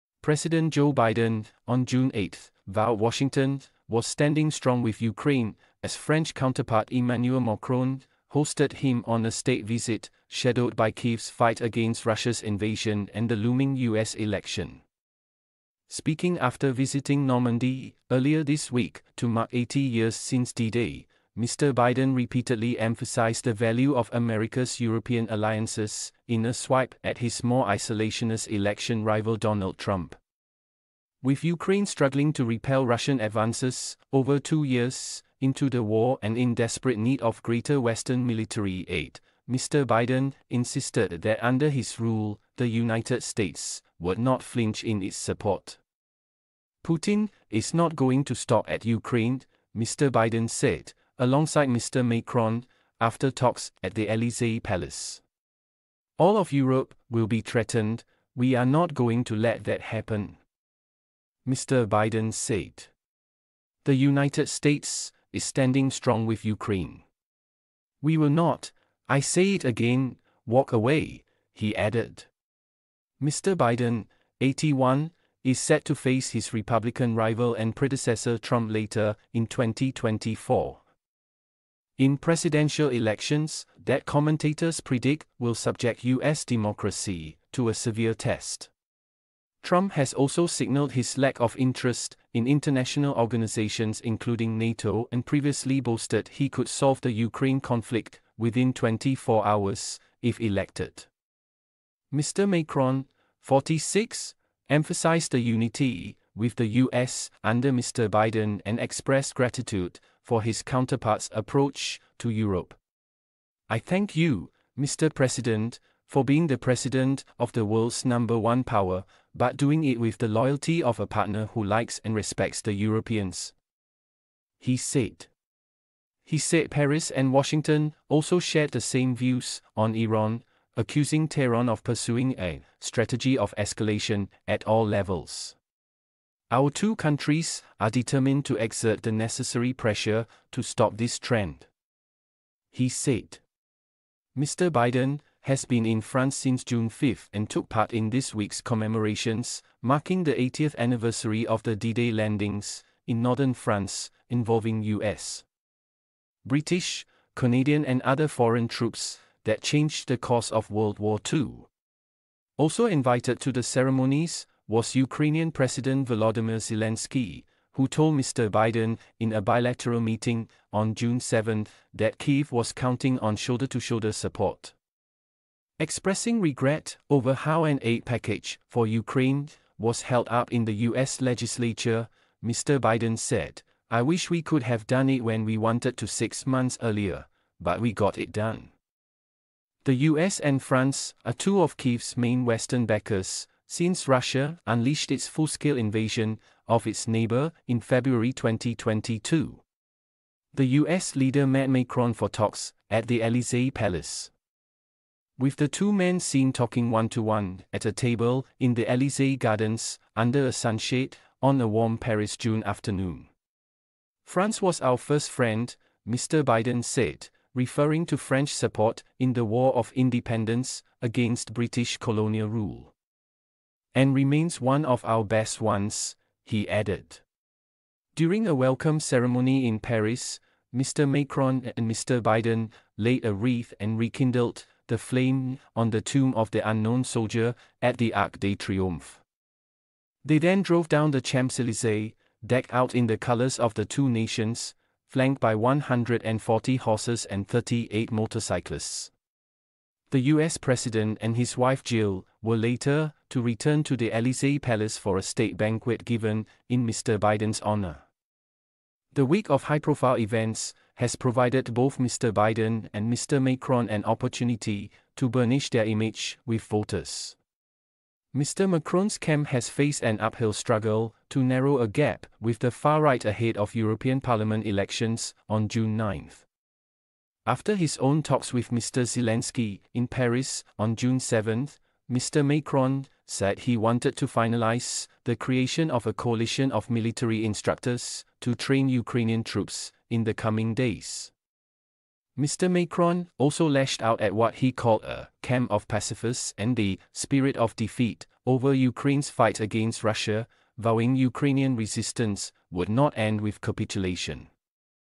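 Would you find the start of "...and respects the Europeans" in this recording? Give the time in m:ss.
2:02.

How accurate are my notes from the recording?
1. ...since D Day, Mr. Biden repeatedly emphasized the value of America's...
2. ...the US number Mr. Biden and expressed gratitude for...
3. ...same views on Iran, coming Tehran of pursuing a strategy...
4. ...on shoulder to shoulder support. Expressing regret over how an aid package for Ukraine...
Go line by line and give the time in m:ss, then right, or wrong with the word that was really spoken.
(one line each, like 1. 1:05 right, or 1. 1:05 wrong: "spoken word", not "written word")
1. 0:20 right
2. 1:46 wrong: "under", not "number"
3. 2:08 wrong: "accusing", not "coming"
4. 2:53 right.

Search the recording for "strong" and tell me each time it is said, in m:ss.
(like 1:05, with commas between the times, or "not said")
0:04, 1:05.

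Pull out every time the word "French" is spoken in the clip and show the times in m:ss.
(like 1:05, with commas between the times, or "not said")
0:05, 3:38.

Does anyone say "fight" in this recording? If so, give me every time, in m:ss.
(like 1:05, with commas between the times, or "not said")
0:11, 4:59.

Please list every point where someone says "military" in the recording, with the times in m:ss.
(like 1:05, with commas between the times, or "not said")
0:38, 4:46.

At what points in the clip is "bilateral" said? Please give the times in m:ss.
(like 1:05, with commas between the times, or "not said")
2:49.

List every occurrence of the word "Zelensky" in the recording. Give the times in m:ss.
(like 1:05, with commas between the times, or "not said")
2:46, 4:39.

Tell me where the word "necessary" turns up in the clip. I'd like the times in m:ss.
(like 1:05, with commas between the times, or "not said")
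2:19.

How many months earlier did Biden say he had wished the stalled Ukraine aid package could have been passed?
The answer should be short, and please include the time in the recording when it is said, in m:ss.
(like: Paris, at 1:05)
6, at 3:06.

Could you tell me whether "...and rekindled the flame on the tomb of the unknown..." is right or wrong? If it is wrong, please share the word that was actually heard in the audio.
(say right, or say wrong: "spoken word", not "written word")
right.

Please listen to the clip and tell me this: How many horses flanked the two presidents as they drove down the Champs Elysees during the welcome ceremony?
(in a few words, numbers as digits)
140.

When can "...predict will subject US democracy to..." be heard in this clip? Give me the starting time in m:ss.
1:24.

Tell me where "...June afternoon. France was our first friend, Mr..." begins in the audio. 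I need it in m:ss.
3:32.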